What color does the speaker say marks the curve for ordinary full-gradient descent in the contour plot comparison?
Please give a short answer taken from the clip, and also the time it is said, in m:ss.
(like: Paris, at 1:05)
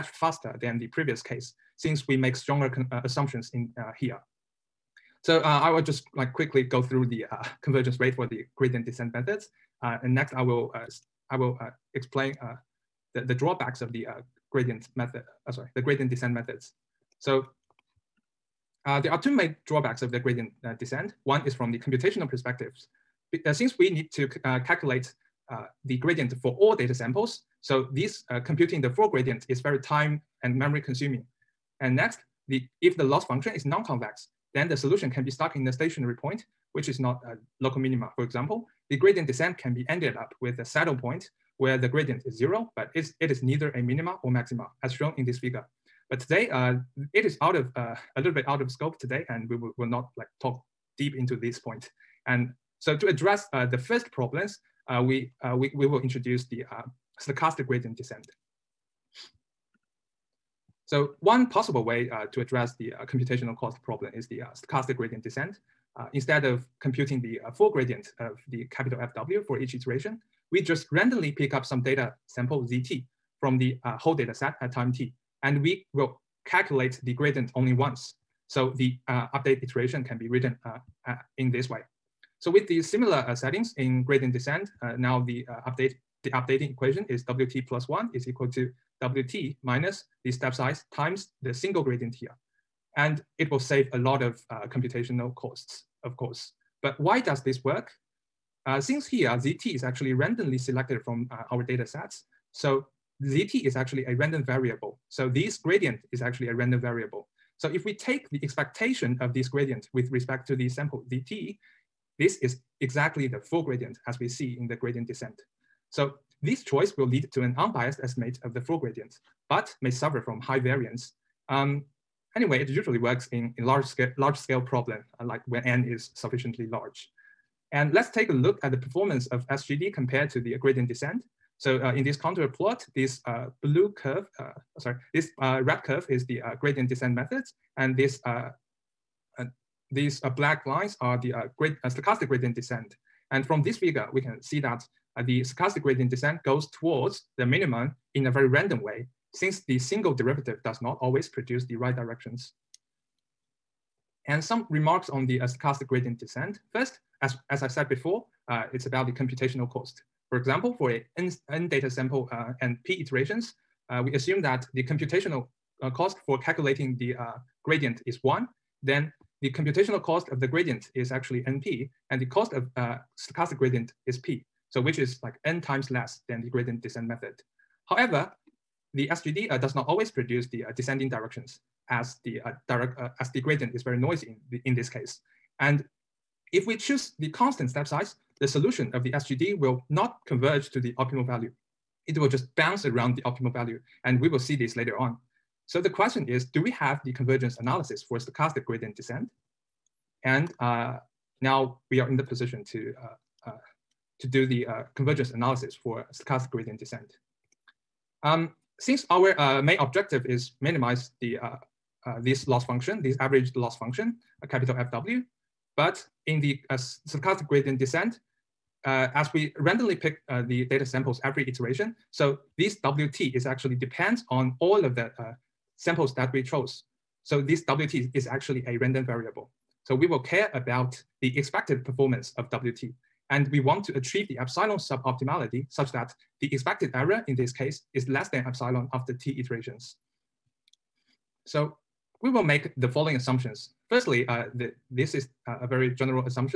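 red, at 2:15.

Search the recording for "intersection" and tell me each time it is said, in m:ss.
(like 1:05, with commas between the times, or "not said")
not said.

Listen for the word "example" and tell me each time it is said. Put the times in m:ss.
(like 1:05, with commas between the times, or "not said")
0:38, 2:40.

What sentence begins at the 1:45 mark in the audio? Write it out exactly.
So this gradient is actually a random variable.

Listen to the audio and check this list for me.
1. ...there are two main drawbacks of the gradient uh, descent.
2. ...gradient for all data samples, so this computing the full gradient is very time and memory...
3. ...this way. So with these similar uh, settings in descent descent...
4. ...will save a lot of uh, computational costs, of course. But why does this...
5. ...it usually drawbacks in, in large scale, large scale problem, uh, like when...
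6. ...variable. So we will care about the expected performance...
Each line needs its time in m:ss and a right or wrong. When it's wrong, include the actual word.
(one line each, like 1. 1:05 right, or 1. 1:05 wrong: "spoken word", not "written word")
1. 0:19 right
2. 0:25 right
3. 1:21 wrong: "gradient", not "descent"
4. 1:33 right
5. 2:02 wrong: "works", not "drawbacks"
6. 3:49 right.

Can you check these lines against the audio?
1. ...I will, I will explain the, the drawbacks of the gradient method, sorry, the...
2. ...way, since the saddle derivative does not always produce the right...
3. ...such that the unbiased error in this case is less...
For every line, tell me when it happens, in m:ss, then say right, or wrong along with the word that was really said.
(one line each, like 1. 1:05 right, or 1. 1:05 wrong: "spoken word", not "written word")
1. 0:10 right
2. 2:28 wrong: "single", not "saddle"
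3. 3:55 wrong: "expected", not "unbiased".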